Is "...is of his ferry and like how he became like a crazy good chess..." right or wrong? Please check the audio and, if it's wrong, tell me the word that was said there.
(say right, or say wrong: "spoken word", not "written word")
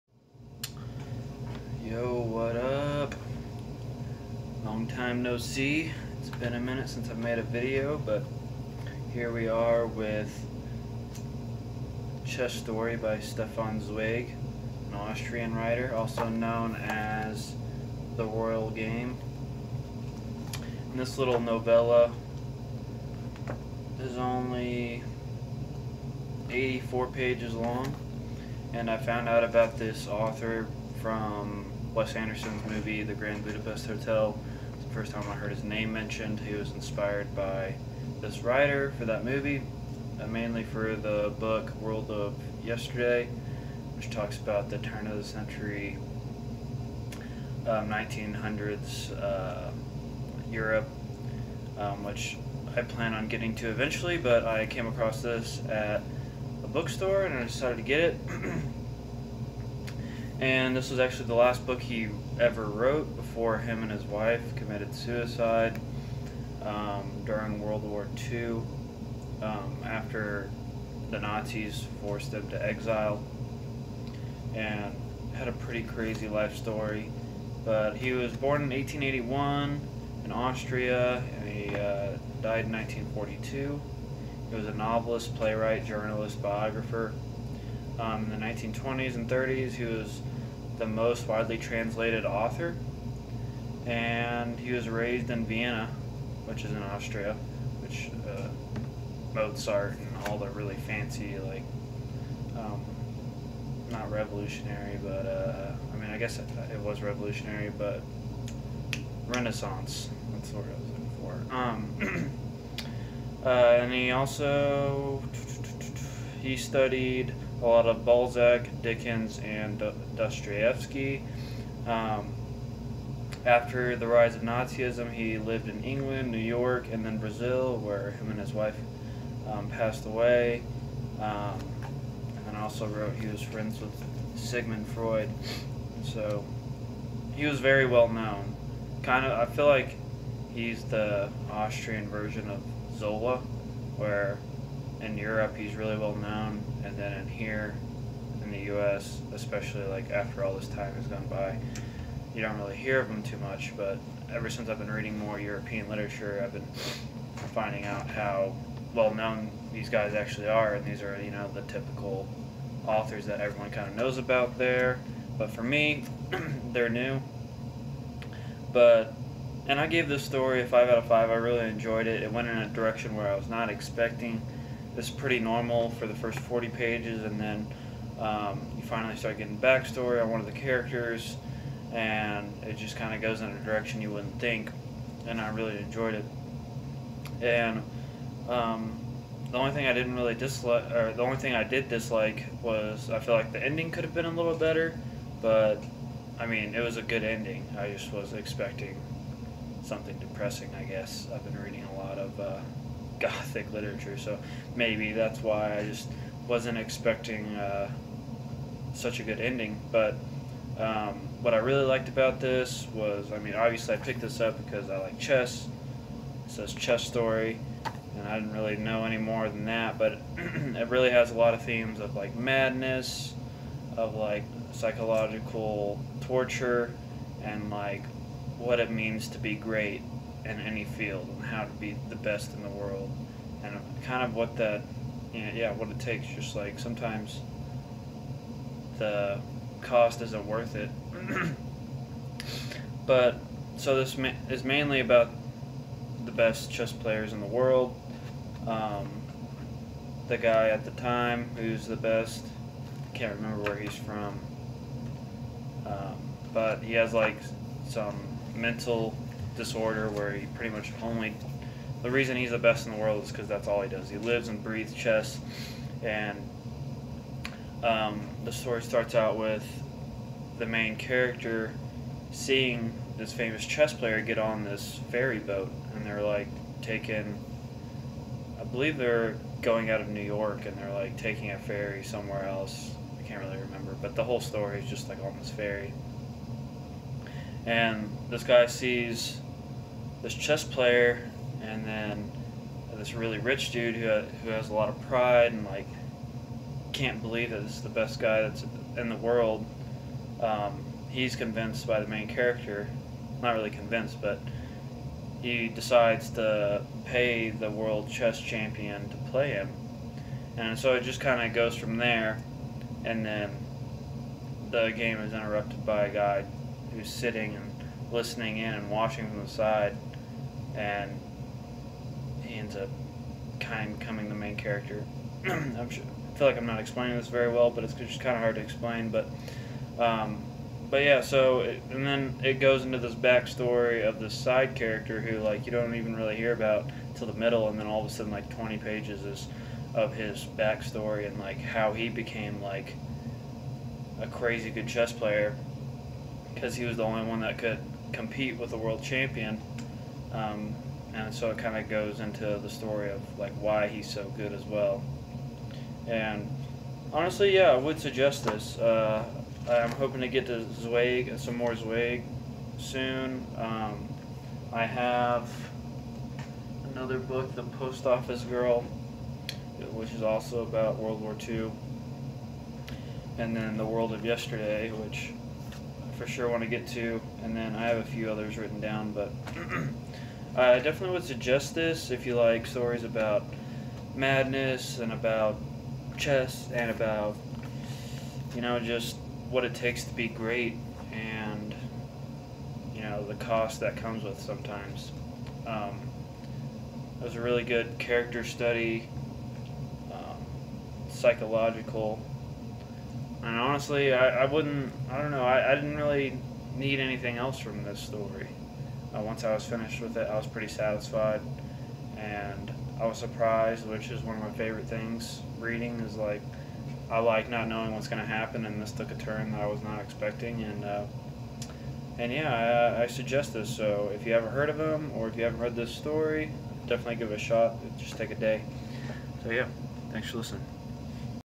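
wrong: "backstory", not "ferry".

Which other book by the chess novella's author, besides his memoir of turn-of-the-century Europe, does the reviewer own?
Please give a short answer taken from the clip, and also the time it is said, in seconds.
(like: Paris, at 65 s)
The Post Office Girl, at 367 s.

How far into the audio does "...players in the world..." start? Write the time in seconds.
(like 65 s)
246 s.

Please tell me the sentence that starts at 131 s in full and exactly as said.
Um, and also wrote he was friends with Sigmund Freud.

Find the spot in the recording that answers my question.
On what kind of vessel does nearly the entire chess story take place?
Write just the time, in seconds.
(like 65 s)
275 s.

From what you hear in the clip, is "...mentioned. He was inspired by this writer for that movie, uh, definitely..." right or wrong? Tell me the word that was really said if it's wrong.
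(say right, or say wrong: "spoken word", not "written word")
wrong: "mainly", not "definitely".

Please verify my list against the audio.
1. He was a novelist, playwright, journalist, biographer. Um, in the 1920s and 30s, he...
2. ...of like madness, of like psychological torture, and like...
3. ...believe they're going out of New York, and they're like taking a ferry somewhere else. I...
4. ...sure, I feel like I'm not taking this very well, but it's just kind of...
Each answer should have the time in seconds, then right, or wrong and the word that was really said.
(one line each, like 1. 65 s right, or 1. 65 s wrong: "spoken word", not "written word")
1. 84 s right
2. 221 s right
3. 278 s right
4. 325 s wrong: "explaining", not "taking".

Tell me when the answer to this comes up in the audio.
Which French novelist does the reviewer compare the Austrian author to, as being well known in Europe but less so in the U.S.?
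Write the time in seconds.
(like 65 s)
142 s.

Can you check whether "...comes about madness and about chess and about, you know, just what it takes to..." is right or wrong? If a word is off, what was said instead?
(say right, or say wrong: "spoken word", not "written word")
wrong: "stories", not "comes".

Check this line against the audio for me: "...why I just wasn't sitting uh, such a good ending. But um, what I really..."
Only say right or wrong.
wrong.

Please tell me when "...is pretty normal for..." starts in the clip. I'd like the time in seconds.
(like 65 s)
175 s.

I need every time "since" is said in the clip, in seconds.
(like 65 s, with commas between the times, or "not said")
6 s, 154 s.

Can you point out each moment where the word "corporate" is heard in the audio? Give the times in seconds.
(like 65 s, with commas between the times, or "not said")
not said.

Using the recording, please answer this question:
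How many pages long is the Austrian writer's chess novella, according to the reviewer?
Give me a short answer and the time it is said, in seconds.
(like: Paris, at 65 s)
84, at 26 s.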